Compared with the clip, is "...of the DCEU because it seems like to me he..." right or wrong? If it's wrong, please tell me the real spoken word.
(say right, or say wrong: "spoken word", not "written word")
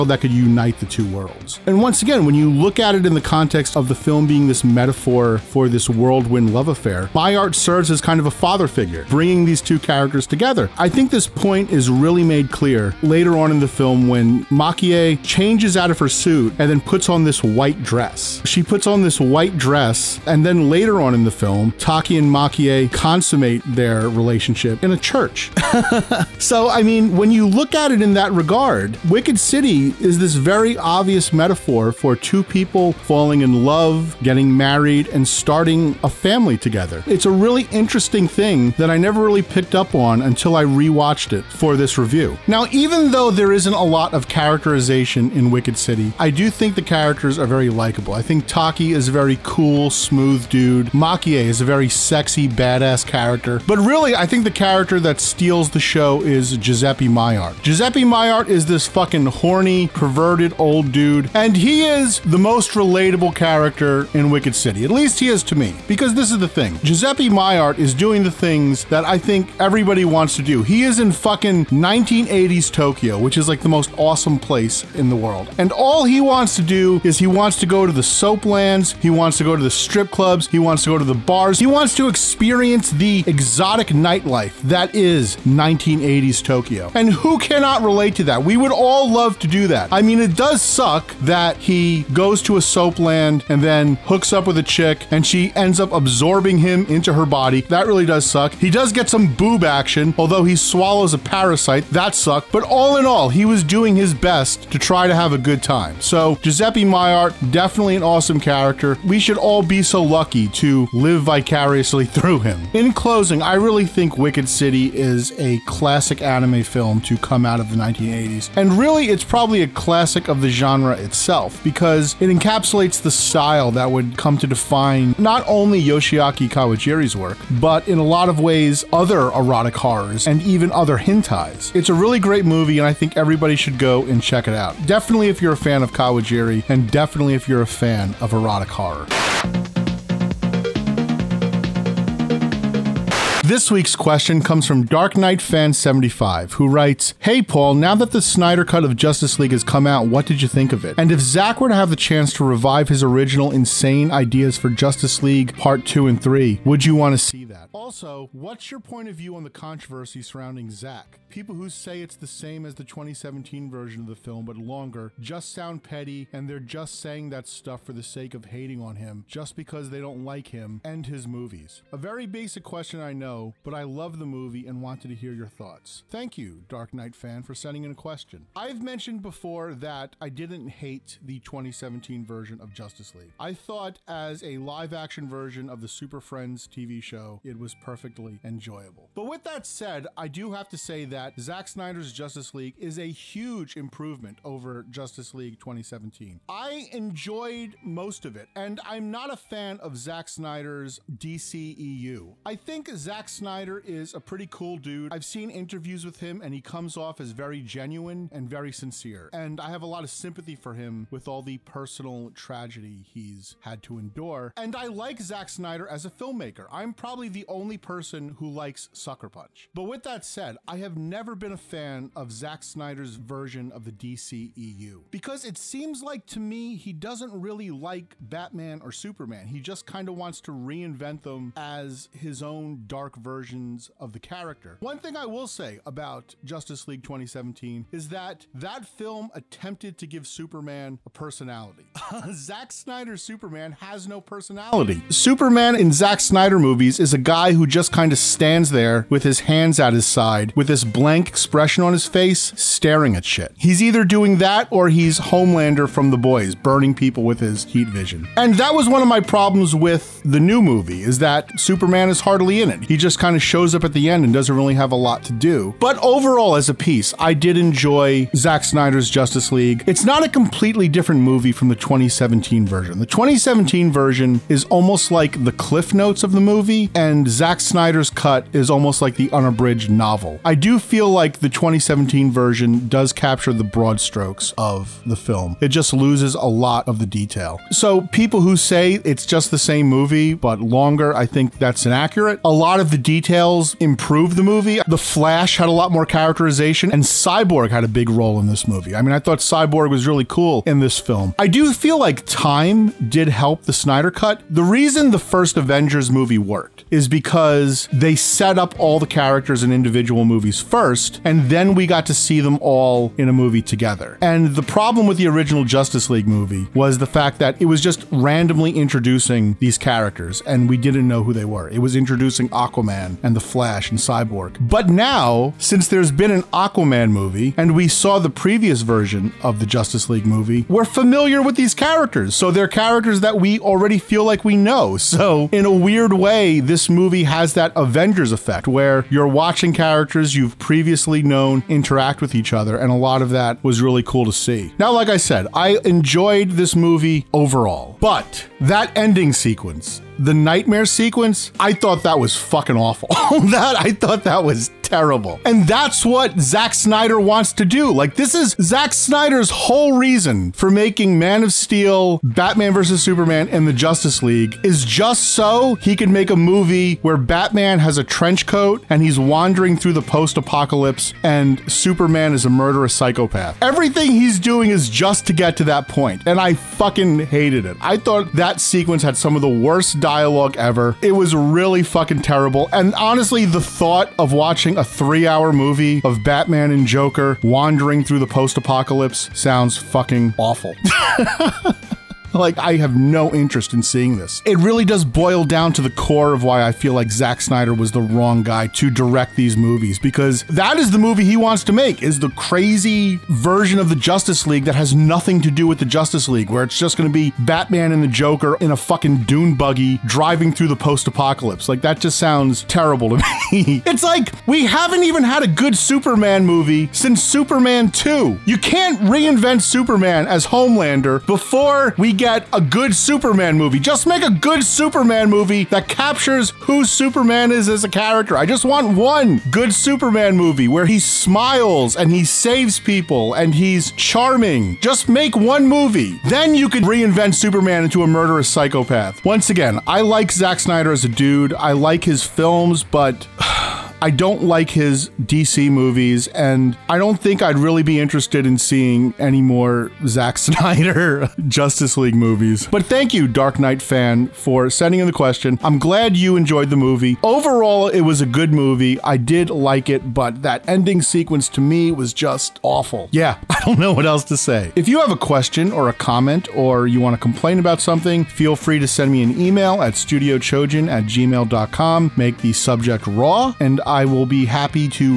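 right.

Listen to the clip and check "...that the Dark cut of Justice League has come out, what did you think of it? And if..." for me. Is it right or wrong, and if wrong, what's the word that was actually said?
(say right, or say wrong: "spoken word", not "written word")
wrong: "Snyder", not "Dark".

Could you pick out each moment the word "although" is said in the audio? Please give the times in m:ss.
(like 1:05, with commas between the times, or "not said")
1:40.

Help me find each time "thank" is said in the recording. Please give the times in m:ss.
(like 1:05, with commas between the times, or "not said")
2:56, 7:32.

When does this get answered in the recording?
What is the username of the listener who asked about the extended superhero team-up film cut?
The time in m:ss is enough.
2:24.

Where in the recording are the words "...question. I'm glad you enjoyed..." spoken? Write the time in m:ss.
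7:35.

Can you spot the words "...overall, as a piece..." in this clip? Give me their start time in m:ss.
4:25.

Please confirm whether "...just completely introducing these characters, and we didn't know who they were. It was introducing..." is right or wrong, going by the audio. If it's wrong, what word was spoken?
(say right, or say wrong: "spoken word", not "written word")
wrong: "randomly", not "completely".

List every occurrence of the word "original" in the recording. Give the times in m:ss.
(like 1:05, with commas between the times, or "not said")
2:33, 5:15.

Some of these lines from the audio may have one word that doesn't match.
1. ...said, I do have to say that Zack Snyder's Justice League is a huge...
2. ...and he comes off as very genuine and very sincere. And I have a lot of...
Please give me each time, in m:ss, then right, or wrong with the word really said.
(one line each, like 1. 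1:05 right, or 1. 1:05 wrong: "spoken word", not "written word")
1. 3:09 right
2. 3:26 right.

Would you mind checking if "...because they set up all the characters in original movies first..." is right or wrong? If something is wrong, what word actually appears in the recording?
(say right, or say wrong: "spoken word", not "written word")
wrong: "individual", not "original".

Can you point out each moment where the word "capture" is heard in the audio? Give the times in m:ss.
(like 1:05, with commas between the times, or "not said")
4:43, 7:05.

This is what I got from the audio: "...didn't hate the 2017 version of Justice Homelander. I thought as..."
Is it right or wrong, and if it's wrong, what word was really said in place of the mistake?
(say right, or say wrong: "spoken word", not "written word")
wrong: "League", not "Homelander".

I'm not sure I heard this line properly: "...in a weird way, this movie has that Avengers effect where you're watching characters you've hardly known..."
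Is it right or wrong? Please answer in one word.
wrong.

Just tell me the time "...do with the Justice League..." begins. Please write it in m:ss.
6:45.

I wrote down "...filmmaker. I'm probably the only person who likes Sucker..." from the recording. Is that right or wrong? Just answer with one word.
right.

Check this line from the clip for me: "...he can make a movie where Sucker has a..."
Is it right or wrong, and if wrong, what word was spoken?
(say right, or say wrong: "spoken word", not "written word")
wrong: "Batman", not "Sucker".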